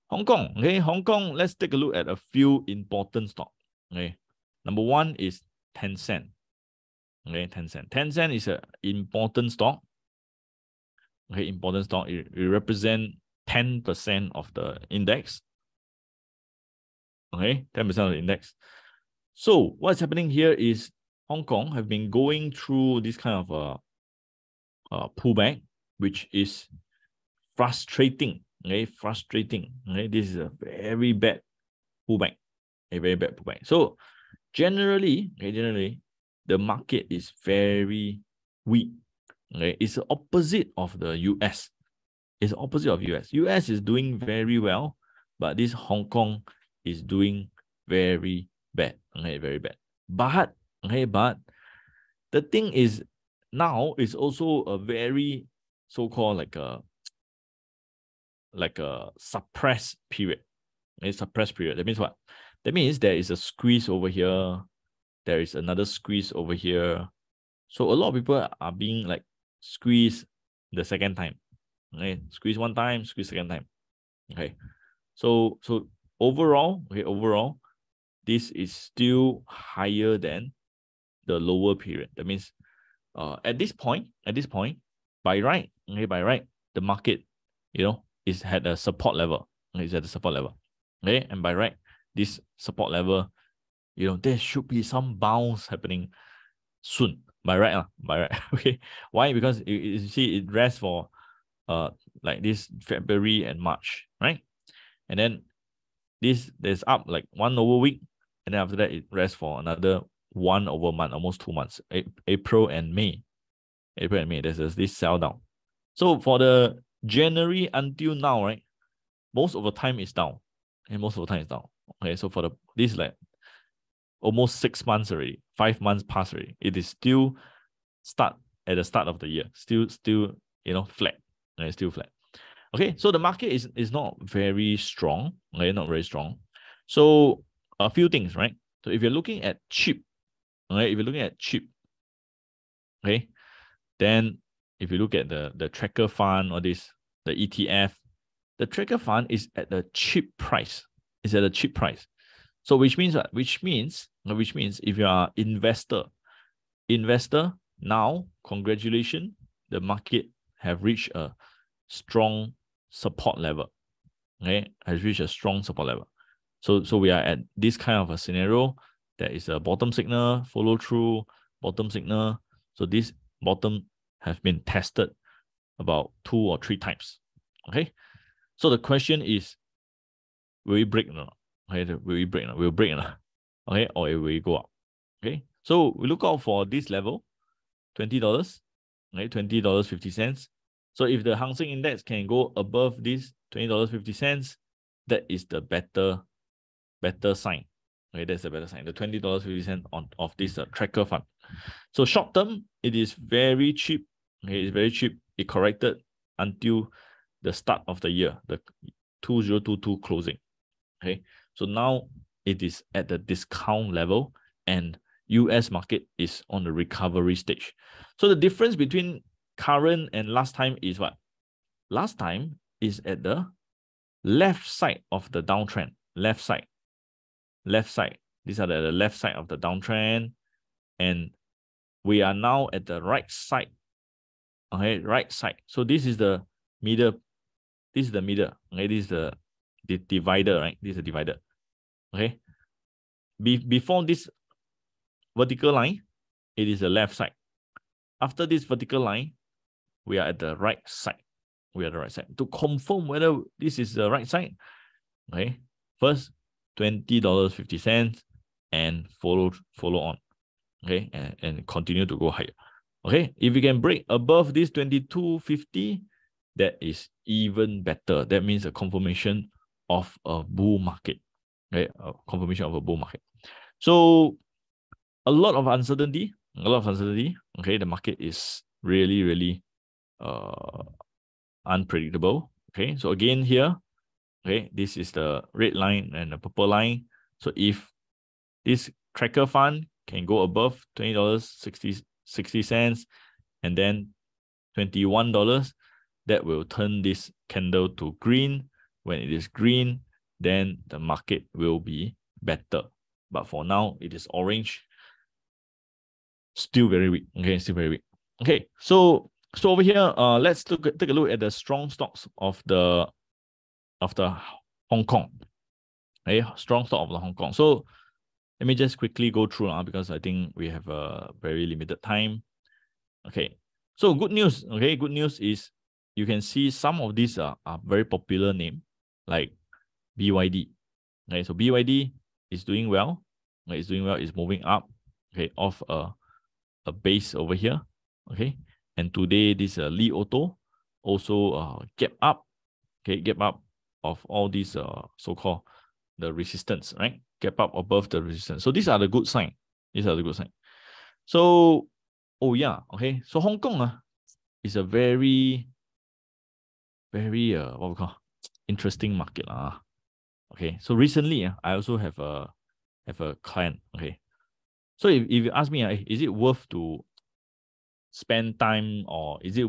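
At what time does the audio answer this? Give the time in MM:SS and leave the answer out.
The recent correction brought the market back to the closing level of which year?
03:29.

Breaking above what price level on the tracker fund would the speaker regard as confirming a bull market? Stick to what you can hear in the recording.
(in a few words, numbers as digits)
22.50.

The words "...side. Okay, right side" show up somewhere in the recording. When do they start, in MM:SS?
03:53.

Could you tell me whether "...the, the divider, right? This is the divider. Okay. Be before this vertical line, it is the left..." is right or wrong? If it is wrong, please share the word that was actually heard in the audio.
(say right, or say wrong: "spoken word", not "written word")
right.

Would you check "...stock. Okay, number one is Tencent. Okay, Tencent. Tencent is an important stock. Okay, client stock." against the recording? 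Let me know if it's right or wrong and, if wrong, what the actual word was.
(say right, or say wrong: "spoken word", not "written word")
wrong: "important", not "client".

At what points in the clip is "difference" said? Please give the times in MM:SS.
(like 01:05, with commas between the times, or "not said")
03:38.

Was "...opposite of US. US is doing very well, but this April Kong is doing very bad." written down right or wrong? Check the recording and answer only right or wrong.
wrong.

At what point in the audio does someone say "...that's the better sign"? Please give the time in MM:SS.
03:18.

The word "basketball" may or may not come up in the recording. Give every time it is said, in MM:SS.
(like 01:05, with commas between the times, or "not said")
not said.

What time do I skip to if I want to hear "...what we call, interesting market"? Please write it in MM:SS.
05:57.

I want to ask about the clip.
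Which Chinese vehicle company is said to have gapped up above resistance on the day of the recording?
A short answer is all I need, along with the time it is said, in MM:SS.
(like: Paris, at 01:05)
Li Auto, at 05:39.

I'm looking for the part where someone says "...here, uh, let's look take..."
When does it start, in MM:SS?
05:09.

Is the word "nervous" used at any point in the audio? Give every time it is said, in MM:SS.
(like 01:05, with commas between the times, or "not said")
not said.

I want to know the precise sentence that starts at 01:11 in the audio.
Okay, squeeze one time, squeeze second time.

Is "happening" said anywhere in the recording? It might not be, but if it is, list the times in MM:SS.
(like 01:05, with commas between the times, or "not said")
00:19, 01:35.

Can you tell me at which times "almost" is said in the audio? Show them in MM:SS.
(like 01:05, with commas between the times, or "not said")
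01:51, 02:04.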